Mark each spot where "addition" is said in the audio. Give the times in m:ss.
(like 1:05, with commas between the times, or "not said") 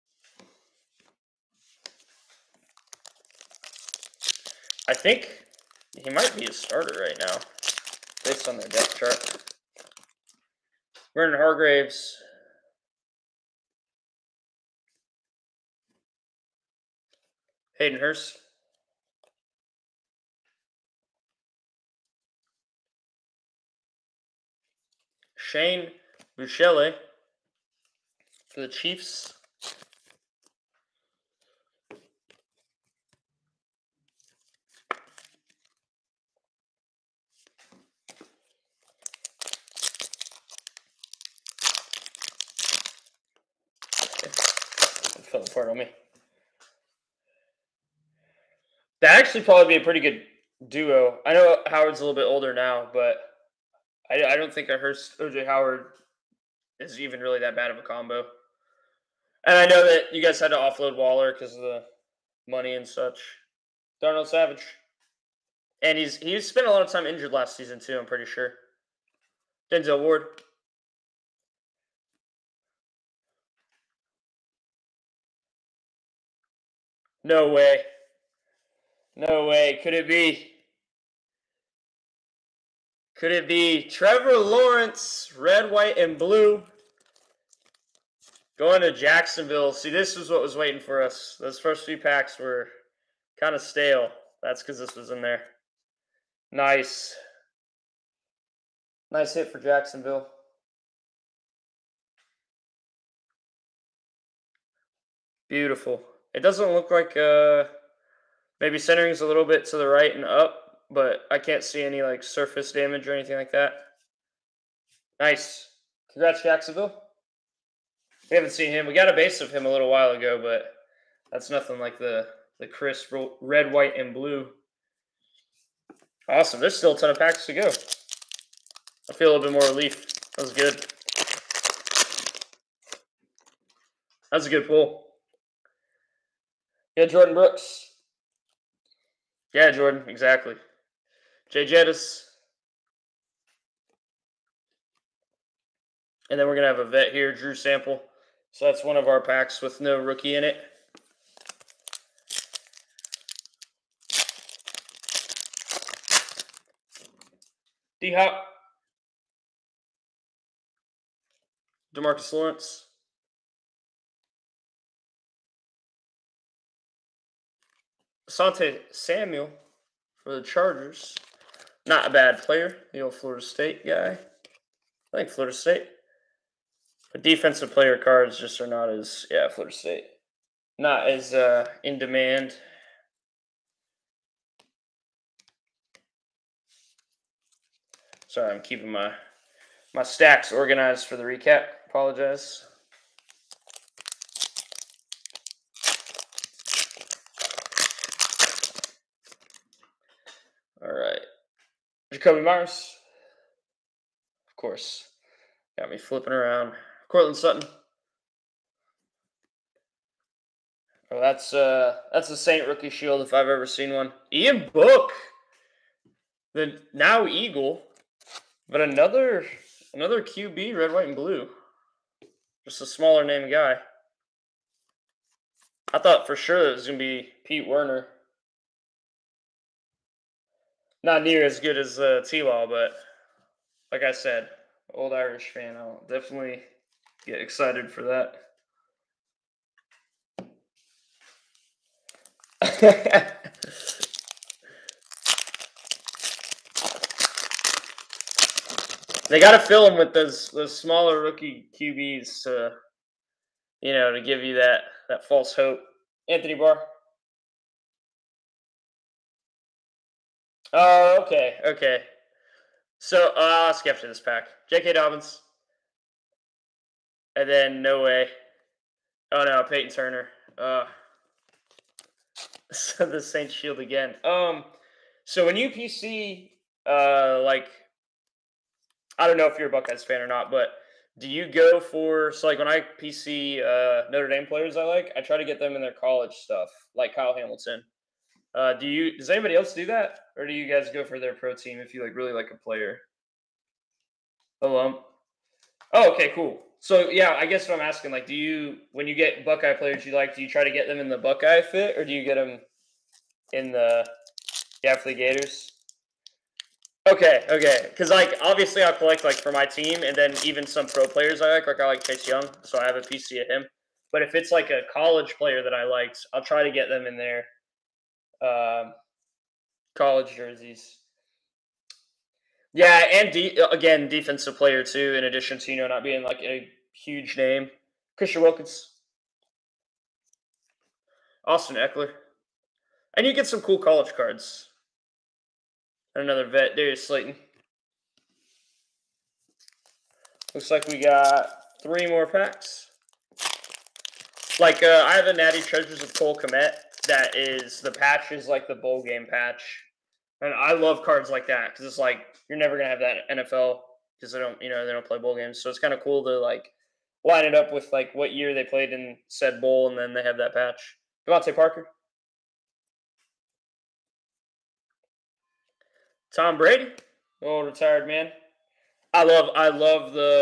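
5:25.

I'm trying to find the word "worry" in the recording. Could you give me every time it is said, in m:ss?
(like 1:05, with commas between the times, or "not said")
not said.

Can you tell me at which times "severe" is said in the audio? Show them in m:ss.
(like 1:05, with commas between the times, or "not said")
not said.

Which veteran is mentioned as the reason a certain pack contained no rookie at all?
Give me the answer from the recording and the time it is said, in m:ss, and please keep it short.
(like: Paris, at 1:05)
Drew Sample, at 2:27.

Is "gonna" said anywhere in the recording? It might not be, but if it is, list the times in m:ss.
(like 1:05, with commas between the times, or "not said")
3:46, 5:52.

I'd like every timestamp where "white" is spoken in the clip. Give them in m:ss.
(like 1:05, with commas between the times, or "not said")
1:25, 2:03, 3:40.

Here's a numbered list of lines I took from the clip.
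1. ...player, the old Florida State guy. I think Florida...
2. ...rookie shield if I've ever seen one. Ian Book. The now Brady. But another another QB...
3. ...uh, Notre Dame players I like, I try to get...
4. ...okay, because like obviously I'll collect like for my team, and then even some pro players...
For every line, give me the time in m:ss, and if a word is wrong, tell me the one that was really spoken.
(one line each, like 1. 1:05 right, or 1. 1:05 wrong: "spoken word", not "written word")
1. 2:52 right
2. 3:32 wrong: "Eagle", not "Brady"
3. 4:43 right
4. 5:07 right.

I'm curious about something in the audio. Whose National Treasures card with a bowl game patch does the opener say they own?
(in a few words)
Cole Kmet.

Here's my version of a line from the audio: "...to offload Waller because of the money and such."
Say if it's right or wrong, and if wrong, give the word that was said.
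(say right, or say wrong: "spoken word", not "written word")
right.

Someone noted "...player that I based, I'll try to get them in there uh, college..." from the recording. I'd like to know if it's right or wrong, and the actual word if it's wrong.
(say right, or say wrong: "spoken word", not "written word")
wrong: "liked", not "based".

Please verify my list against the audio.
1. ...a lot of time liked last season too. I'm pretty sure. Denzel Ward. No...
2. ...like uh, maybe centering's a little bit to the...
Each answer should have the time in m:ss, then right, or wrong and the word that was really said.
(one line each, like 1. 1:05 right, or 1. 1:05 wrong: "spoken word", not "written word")
1. 1:06 wrong: "injured", not "liked"
2. 1:46 right.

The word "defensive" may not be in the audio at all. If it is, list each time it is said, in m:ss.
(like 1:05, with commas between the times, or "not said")
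2:57, 5:24.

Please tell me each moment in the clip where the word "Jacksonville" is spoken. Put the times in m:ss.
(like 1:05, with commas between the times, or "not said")
1:28, 1:39, 1:56.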